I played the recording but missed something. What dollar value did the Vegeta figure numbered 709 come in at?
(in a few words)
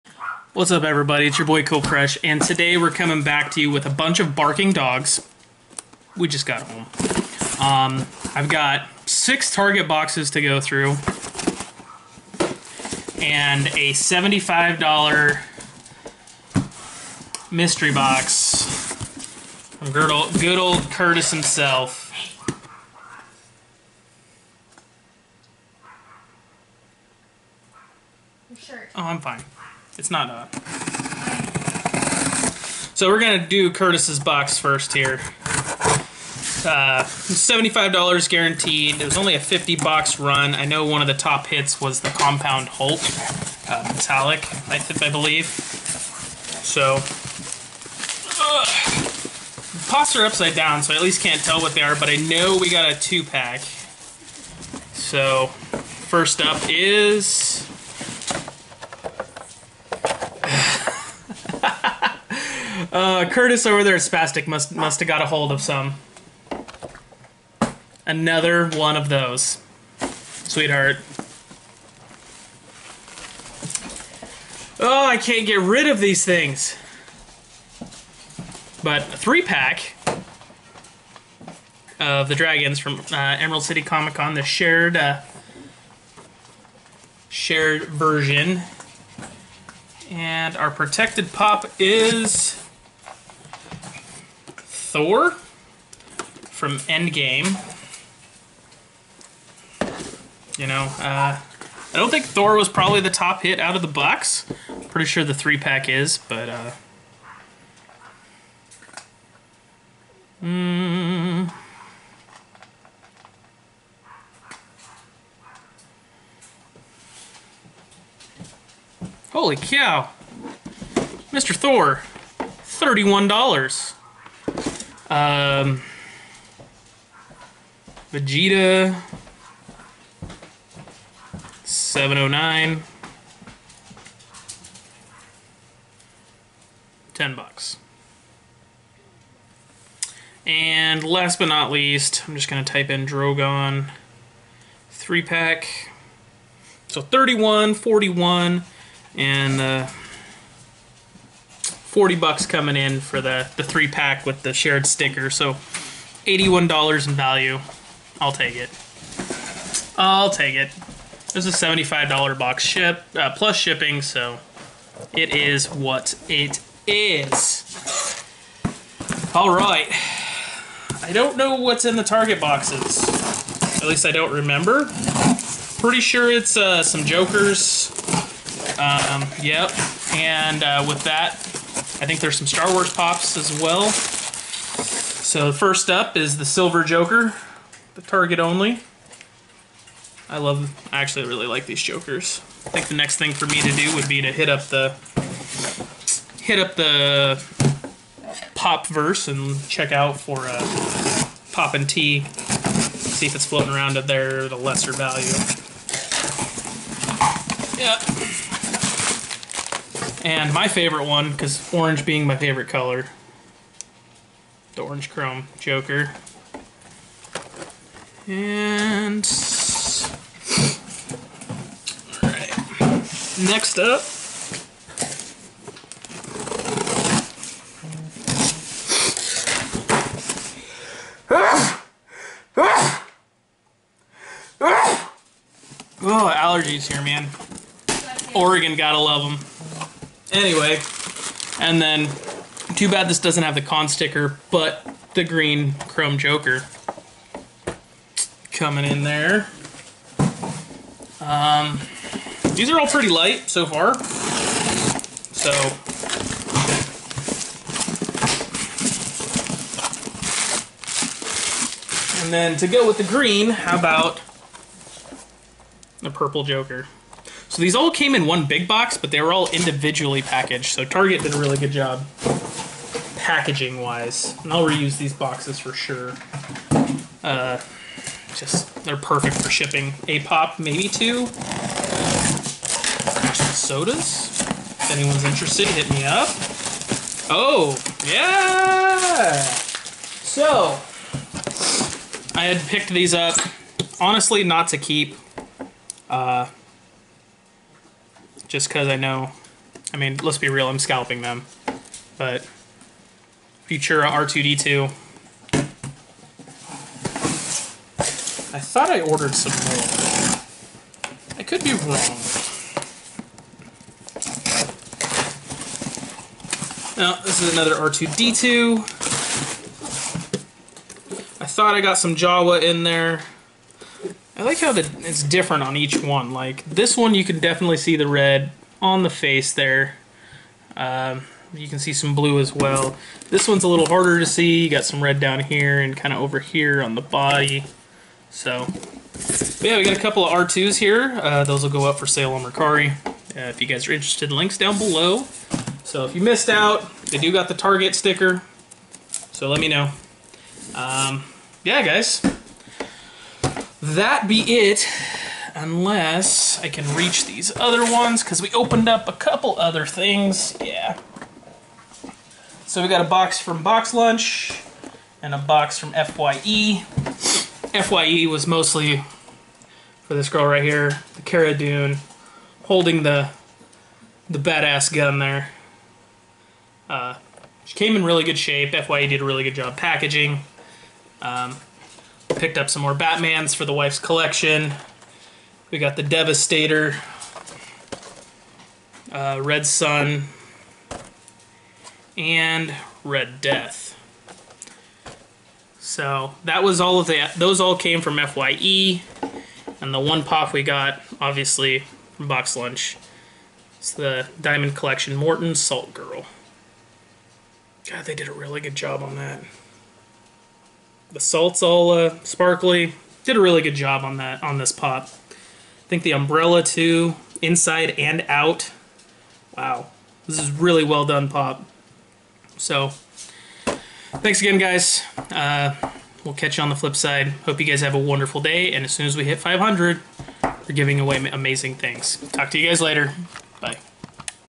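$10.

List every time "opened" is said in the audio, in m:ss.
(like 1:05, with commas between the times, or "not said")
5:58.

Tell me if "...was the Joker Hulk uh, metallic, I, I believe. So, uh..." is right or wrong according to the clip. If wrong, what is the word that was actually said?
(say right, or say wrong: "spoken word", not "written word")
wrong: "Compound", not "Joker".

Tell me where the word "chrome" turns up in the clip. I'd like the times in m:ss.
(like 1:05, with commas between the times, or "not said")
3:35, 4:05.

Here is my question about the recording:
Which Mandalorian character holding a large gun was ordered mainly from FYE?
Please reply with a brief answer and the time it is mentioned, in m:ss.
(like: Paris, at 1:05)
Cara Dune, at 6:11.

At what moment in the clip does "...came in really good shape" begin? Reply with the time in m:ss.
6:17.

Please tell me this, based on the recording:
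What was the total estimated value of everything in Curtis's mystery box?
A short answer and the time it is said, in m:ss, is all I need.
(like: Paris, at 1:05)
$81, at 2:36.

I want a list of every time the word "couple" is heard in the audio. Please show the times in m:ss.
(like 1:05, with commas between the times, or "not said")
5:39, 5:59.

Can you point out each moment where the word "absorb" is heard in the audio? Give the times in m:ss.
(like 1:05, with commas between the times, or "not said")
not said.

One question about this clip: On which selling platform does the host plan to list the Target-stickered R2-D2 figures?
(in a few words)
Mercari.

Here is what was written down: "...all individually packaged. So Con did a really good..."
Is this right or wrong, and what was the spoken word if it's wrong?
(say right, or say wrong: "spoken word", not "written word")
wrong: "Target", not "Con".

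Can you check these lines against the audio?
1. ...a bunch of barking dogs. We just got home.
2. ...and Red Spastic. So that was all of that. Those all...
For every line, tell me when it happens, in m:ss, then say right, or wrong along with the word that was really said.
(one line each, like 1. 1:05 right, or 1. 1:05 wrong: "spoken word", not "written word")
1. 0:03 right
2. 6:32 wrong: "Death", not "Spastic".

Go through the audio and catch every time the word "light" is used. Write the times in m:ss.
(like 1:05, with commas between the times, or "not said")
4:13.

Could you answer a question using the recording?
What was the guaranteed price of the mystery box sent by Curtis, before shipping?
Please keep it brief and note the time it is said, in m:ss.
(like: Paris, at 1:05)
$75, at 0:37.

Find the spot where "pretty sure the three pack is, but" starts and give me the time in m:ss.
1:44.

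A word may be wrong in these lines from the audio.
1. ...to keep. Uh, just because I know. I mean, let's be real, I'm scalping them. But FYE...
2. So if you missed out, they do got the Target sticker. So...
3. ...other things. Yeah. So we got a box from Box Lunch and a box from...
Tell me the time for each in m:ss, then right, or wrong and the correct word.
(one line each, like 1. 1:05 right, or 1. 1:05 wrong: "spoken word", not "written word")
1. 4:54 wrong: "Futura", not "FYE"
2. 5:45 right
3. 5:59 right.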